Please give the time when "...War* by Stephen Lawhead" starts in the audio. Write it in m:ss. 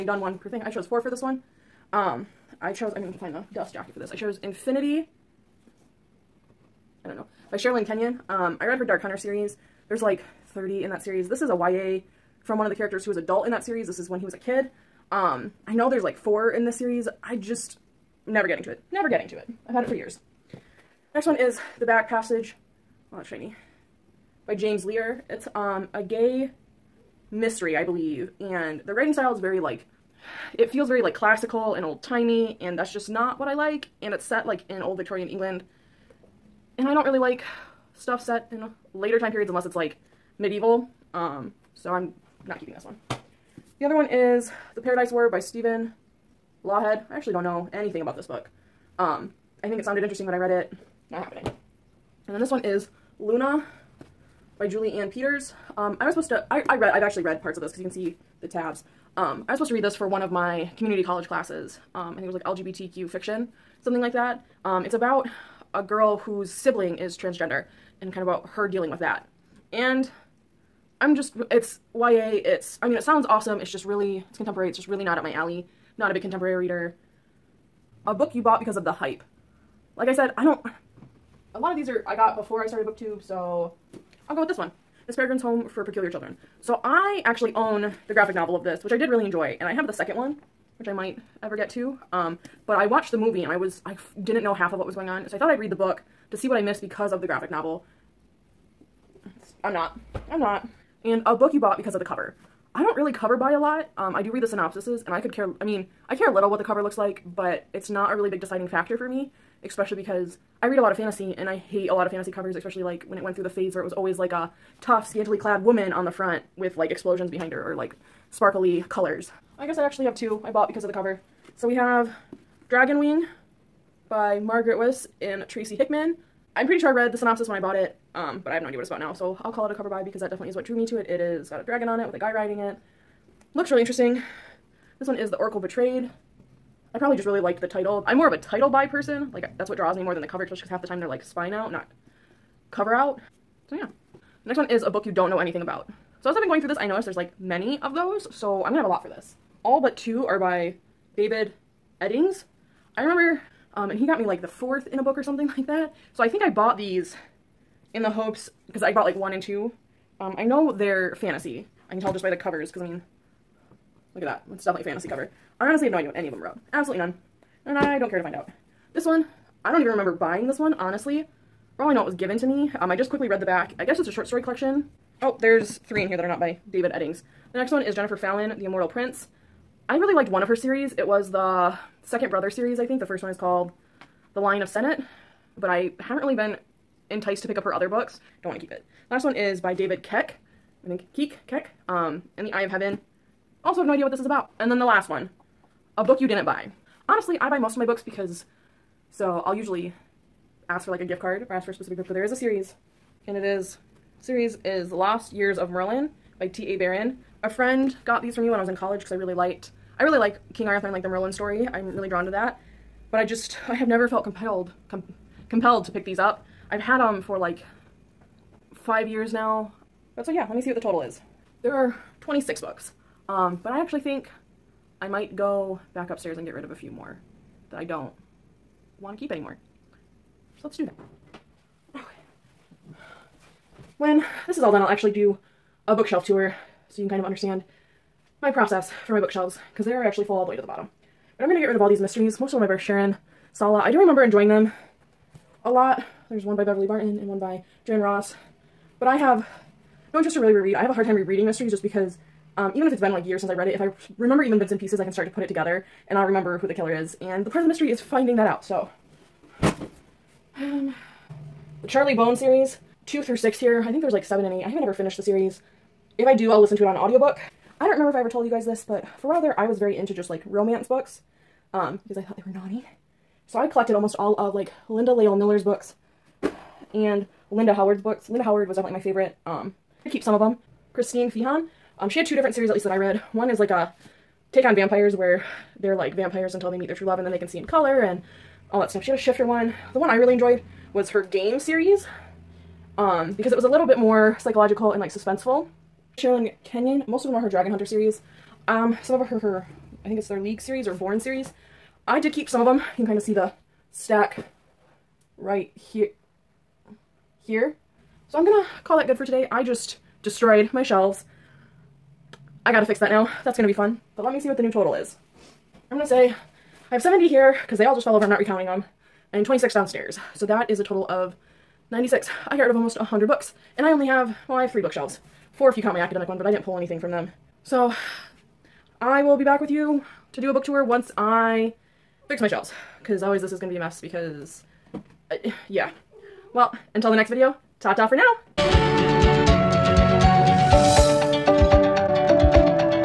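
0:45.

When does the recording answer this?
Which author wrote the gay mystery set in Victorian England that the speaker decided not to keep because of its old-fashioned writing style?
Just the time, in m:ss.
0:24.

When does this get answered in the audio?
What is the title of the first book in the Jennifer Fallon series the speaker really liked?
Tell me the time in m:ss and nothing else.
3:04.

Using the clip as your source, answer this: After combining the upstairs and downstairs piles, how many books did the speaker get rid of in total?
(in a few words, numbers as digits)
96.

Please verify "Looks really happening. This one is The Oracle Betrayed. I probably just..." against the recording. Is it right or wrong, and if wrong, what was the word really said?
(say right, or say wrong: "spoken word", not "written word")
wrong: "interesting", not "happening".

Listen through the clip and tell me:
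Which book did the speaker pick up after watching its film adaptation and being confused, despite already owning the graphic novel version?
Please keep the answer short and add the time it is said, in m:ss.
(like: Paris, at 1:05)
Miss Peregrine's Home for Peculiar Children, at 1:25.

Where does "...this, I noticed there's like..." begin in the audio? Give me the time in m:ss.
2:26.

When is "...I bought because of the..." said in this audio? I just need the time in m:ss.
2:00.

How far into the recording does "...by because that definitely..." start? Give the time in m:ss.
2:09.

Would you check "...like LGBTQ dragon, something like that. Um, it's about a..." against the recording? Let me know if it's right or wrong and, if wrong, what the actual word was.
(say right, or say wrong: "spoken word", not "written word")
wrong: "fiction", not "dragon".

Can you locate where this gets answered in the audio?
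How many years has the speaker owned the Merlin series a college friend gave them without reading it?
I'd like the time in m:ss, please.
3:38.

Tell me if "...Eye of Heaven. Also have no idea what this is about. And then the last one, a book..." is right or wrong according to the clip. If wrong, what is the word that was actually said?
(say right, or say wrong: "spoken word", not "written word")
right.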